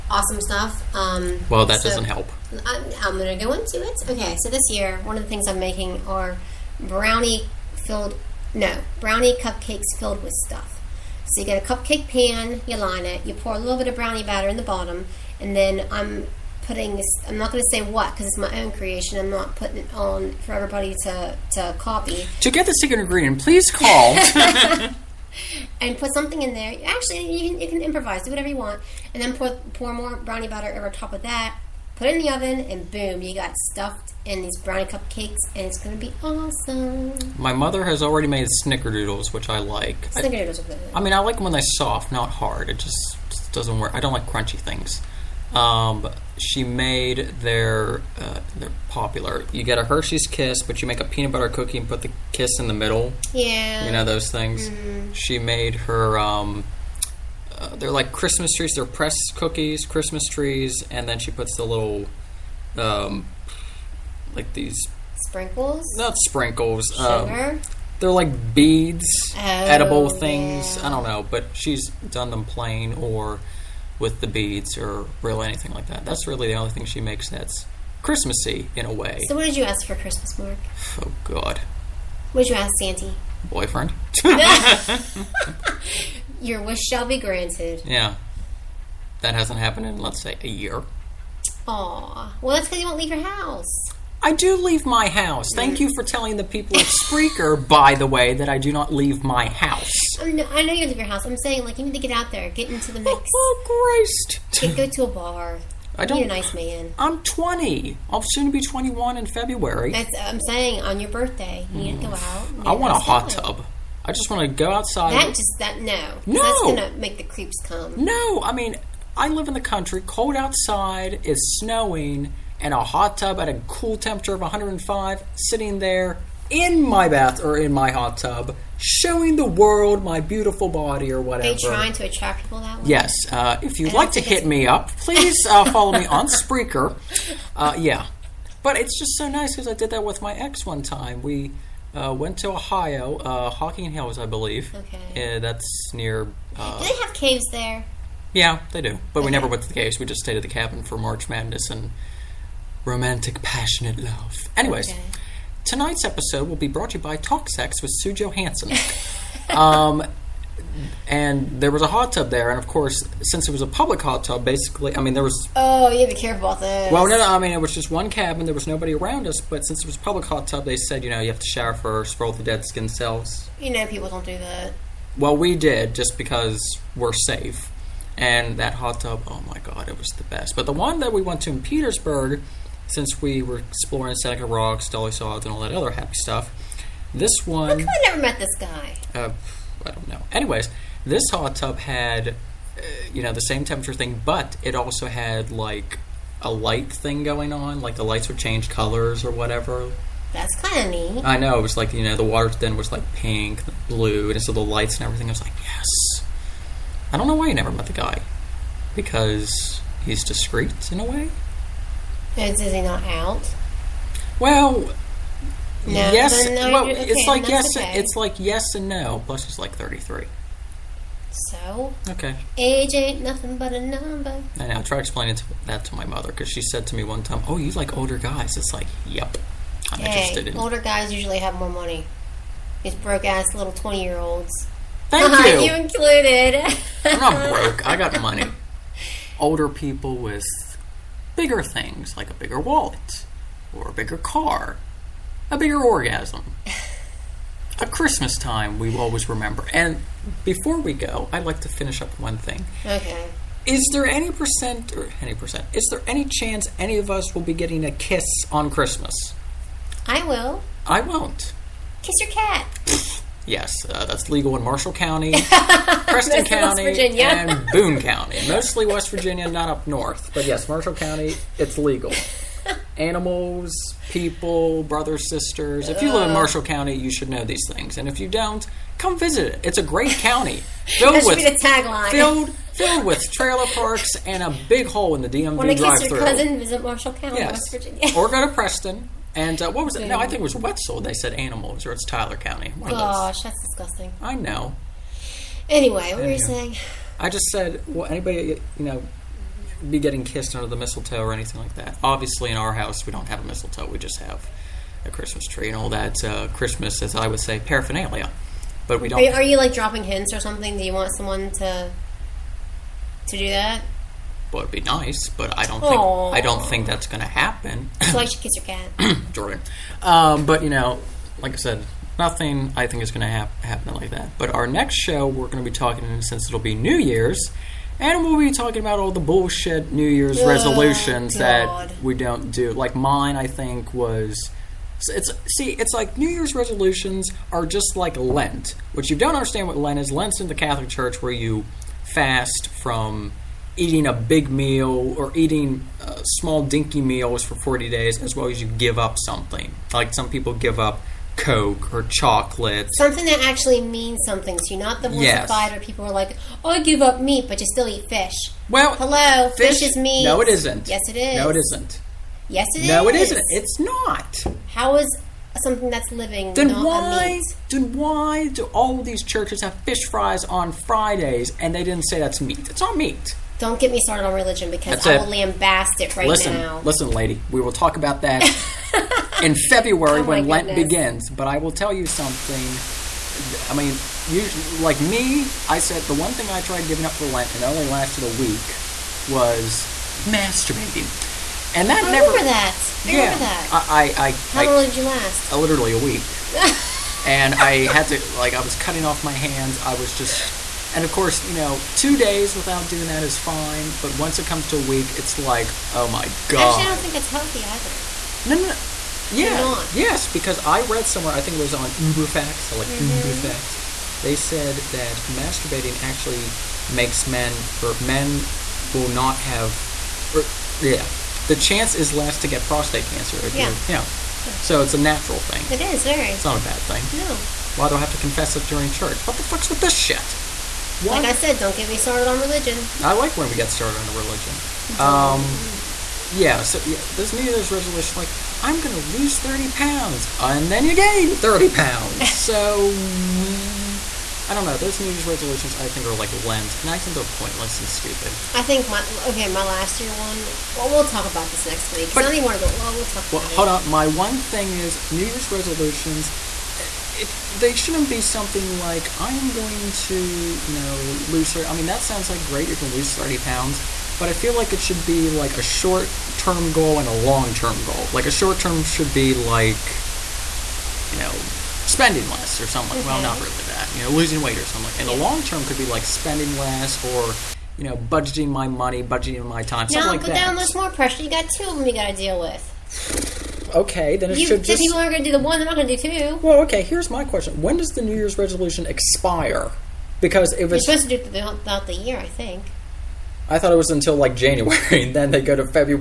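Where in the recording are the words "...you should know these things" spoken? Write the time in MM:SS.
04:36.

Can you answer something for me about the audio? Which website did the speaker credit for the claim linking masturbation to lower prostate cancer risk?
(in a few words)
UberFacts.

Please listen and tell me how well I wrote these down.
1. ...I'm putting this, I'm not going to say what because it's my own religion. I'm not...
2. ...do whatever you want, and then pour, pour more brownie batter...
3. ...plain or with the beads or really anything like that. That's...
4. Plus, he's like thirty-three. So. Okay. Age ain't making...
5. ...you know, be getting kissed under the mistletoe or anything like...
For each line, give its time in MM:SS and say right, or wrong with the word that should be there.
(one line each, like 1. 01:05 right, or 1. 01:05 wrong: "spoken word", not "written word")
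1. 00:15 wrong: "creation", not "religion"
2. 00:28 right
3. 01:12 right
4. 03:39 wrong: "nothing", not "making"
5. 04:58 right.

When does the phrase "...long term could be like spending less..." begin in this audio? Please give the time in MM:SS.
07:55.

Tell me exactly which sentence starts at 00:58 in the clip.
They're pressed cookies, Christmas trees, and then she puts the little, um, like these sprinkles.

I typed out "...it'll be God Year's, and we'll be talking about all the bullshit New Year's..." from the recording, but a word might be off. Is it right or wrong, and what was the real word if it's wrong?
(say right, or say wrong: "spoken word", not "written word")
wrong: "New", not "God".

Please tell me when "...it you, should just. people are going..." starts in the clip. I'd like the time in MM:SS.
08:04.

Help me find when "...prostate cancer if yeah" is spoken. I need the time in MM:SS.
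07:02.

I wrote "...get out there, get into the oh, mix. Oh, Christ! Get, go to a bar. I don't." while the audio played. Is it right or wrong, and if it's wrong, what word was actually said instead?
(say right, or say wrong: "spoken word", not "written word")
right.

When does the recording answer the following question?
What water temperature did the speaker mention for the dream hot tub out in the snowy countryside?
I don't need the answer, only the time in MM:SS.
02:04.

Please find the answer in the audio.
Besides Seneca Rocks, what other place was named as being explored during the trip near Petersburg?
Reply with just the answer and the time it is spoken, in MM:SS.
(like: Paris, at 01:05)
Dolly Sods, at 03:04.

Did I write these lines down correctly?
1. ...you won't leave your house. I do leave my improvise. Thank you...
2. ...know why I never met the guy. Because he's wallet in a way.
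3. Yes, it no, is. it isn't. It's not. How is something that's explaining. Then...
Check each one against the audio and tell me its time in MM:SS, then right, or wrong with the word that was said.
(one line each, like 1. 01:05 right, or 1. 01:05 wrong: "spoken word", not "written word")
1. 01:32 wrong: "house", not "improvise"
2. 03:27 wrong: "discreet", not "wallet"
3. 06:02 wrong: "living", not "explaining".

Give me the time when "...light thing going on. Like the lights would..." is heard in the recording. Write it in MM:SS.
03:16.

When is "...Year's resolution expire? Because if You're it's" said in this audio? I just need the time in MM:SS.
08:08.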